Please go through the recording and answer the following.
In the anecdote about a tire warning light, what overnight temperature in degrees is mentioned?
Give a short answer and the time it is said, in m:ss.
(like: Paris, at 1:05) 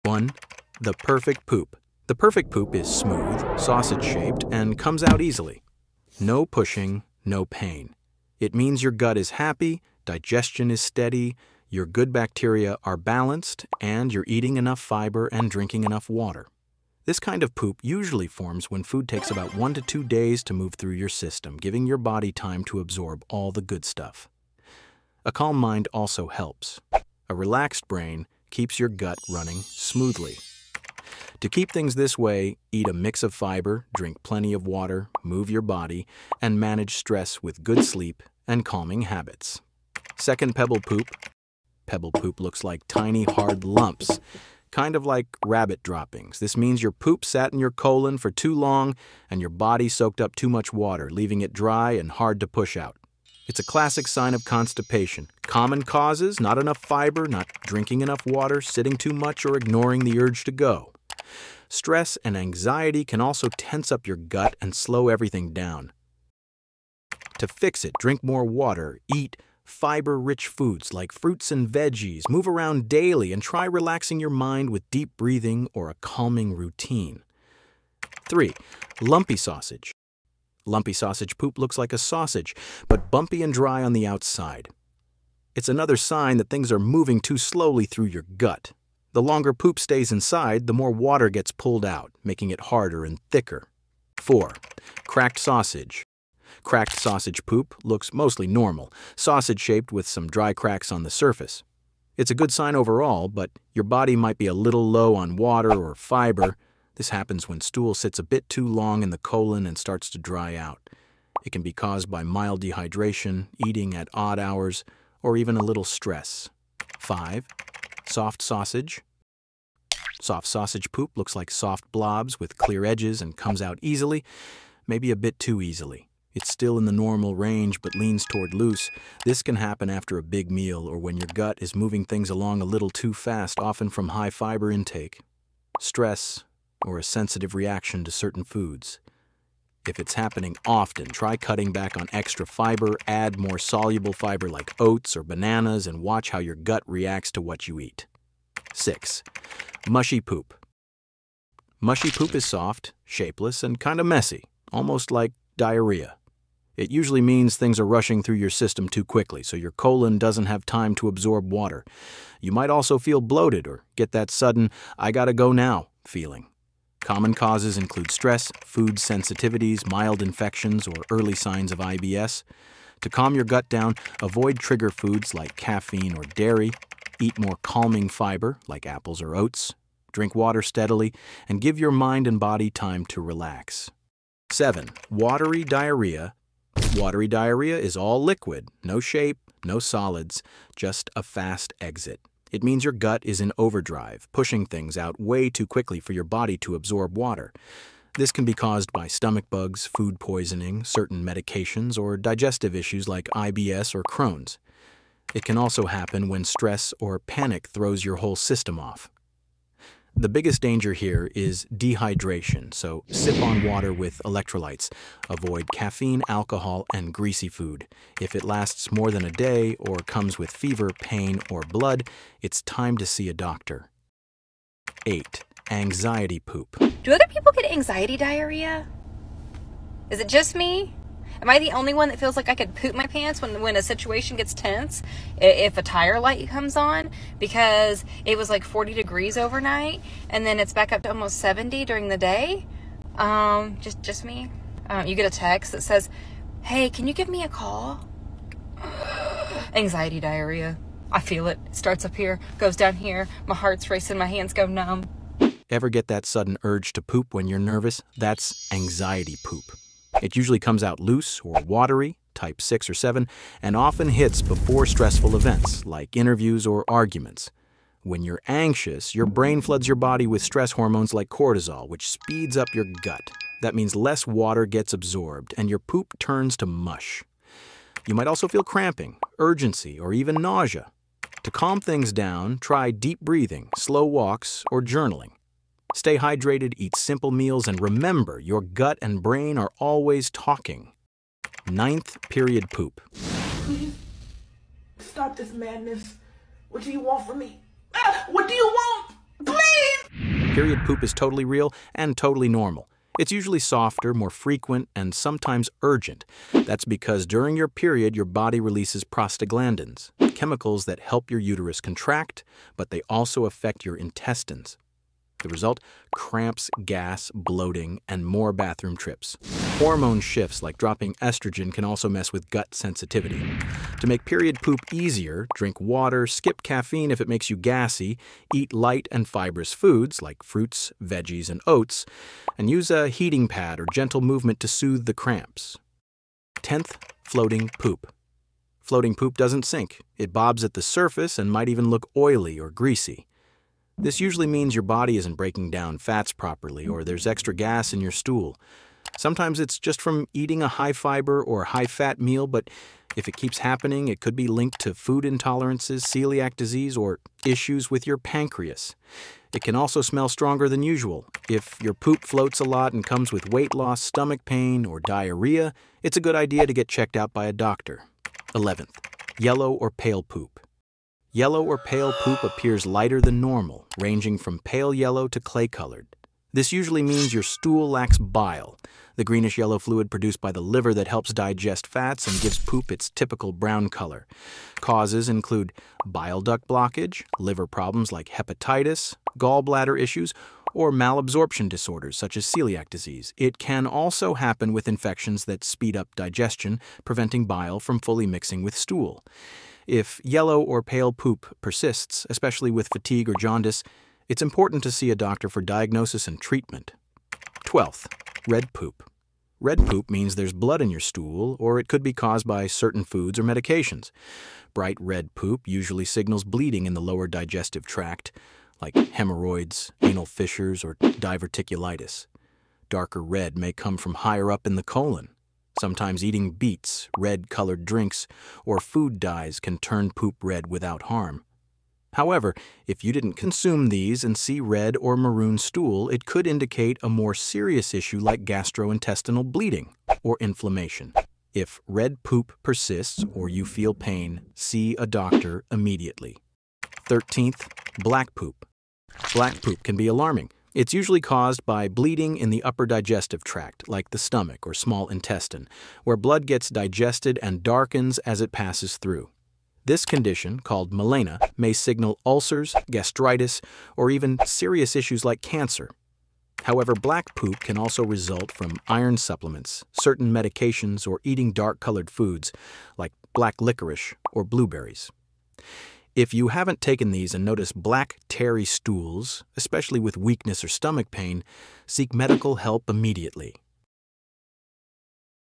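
40 degrees, at 3:58.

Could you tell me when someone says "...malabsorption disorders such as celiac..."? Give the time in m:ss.
6:30.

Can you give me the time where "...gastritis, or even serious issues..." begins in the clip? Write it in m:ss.
7:42.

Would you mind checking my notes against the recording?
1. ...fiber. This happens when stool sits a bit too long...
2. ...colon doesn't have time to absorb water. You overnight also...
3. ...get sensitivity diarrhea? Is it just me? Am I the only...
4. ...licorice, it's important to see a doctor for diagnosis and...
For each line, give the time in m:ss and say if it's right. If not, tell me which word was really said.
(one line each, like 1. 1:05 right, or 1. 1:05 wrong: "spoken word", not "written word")
1. 1:45 right
2. 2:39 wrong: "might", not "overnight"
3. 3:47 wrong: "anxiety", not "sensitivity"
4. 6:43 wrong: "jaundice", not "licorice".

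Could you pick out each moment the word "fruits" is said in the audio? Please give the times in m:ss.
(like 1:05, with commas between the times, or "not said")
1:11, 5:30.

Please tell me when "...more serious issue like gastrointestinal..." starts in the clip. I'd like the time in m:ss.
7:17.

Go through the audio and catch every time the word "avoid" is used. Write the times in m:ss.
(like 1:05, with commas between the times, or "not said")
2:54, 3:35.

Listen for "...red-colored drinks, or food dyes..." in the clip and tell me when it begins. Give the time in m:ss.
7:07.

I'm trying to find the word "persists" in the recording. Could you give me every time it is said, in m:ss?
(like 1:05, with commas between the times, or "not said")
6:41, 7:22.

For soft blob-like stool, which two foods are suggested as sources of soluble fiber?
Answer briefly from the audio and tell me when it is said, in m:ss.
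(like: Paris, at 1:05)
Oats or bananas, at 2:24.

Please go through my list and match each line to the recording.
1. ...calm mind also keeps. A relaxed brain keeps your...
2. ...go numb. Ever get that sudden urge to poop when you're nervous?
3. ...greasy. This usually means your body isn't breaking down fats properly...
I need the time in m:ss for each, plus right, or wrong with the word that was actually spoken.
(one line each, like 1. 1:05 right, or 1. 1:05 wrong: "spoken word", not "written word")
1. 0:25 wrong: "helps", not "keeps"
2. 4:14 right
3. 5:42 right.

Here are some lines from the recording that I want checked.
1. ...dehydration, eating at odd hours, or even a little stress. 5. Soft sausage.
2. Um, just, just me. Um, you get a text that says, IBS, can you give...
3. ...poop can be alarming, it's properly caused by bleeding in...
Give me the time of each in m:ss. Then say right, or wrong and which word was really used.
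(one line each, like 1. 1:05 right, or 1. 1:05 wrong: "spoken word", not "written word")
1. 1:52 right
2. 4:03 wrong: "Hey", not "IBS"
3. 7:29 wrong: "usually", not "properly".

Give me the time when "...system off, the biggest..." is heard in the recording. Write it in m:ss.
3:28.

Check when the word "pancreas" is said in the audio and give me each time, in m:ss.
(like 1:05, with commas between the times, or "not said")
5:58.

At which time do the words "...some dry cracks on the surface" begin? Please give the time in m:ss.
1:40.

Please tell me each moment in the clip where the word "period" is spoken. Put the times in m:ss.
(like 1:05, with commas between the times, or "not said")
4:52, 5:00, 5:07, 5:24.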